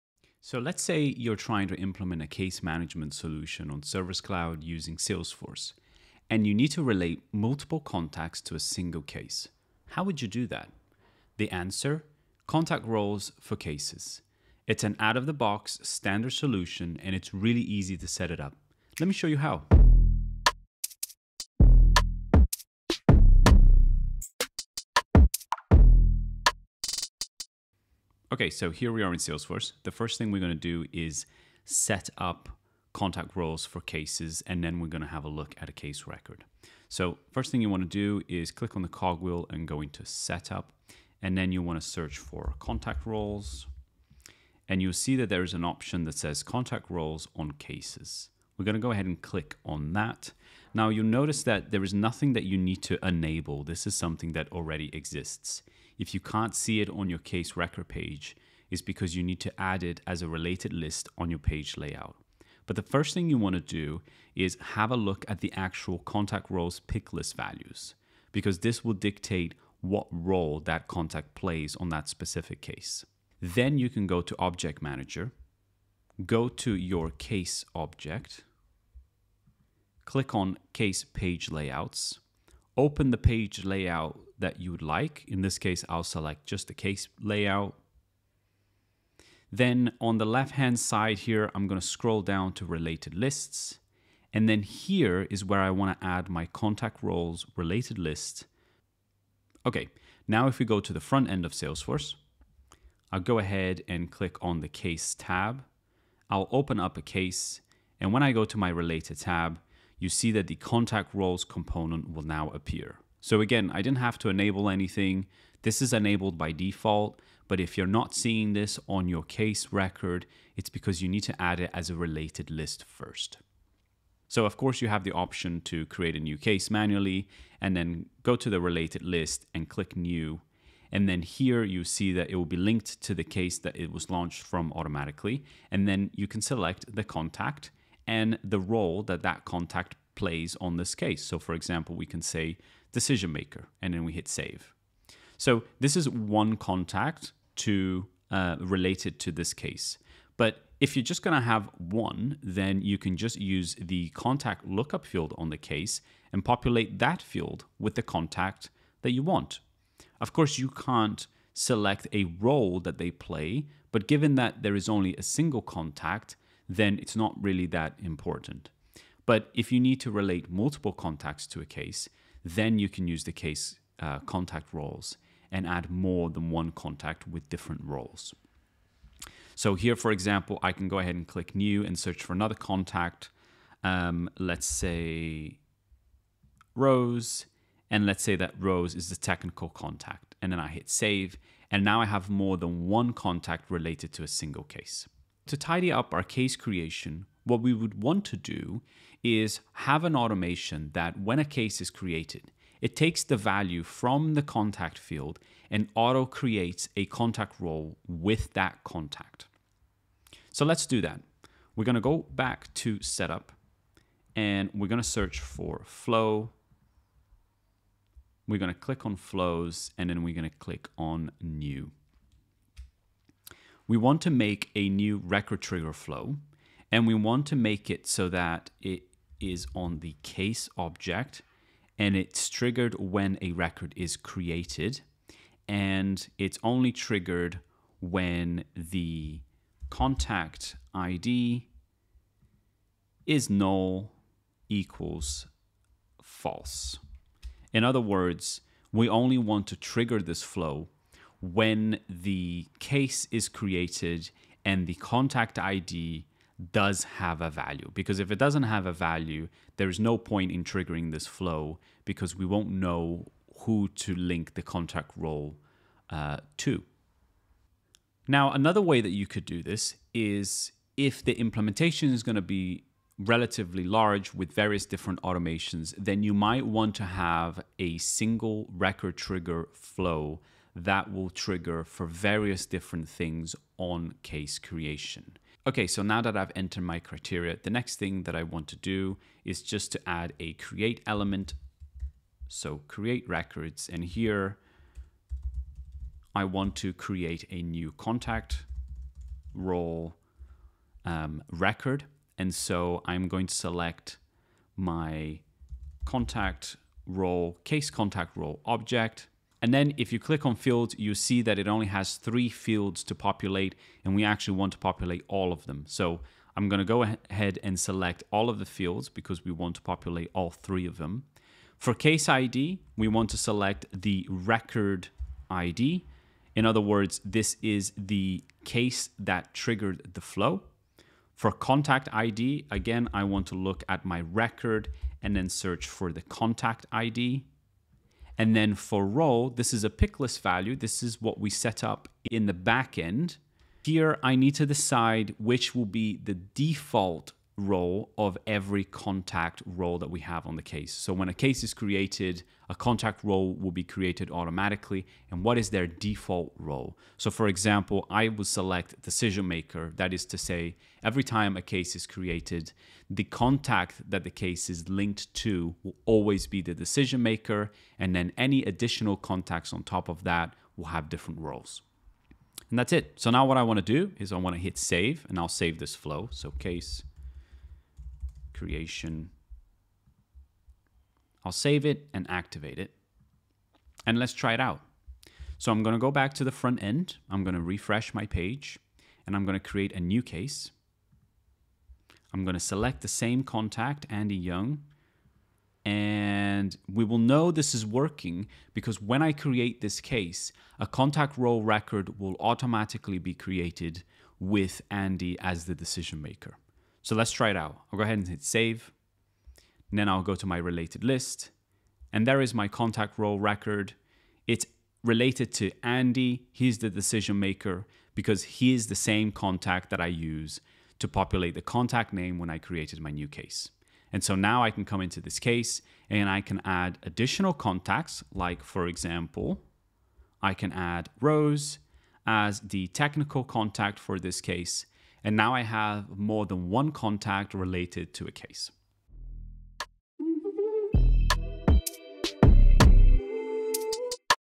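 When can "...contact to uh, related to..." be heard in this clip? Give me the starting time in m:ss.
2:26.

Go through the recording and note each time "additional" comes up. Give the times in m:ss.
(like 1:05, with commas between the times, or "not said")
6:08, 7:07.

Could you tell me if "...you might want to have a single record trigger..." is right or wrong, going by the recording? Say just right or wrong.
right.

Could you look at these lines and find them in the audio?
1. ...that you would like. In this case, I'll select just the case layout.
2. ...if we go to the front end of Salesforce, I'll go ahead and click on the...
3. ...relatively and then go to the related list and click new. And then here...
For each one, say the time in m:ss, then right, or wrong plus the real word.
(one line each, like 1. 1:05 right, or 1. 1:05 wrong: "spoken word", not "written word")
1. 1:24 right
2. 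1:40 right
3. 2:06 wrong: "manually", not "relatively".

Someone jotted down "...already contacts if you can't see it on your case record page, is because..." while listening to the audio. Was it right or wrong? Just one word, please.
wrong.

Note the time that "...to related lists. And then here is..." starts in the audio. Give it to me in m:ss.
1:32.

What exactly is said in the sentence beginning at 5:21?
For case ID, we want to select the record ID.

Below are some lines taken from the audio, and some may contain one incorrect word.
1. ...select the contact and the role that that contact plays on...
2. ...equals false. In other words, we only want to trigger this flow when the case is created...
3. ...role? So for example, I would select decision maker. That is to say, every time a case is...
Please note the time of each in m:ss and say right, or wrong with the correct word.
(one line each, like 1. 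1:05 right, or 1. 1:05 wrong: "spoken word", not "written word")
1. 2:16 right
2. 4:04 right
3. 5:56 right.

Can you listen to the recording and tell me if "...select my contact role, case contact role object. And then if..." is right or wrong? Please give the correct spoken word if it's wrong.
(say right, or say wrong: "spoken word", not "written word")
right.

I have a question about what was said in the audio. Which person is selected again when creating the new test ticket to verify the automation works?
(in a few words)
Andy Young.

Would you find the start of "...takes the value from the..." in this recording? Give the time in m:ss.
3:22.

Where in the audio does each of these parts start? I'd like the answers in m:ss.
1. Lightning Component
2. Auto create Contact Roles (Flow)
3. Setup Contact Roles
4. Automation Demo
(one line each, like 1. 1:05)
1. 1:43
2. 3:14
3. 0:27
4. 6:23.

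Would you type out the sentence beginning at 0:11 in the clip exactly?
The answer contact roles for cases.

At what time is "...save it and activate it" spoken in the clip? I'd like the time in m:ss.
6:21.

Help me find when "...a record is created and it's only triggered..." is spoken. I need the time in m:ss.
3:53.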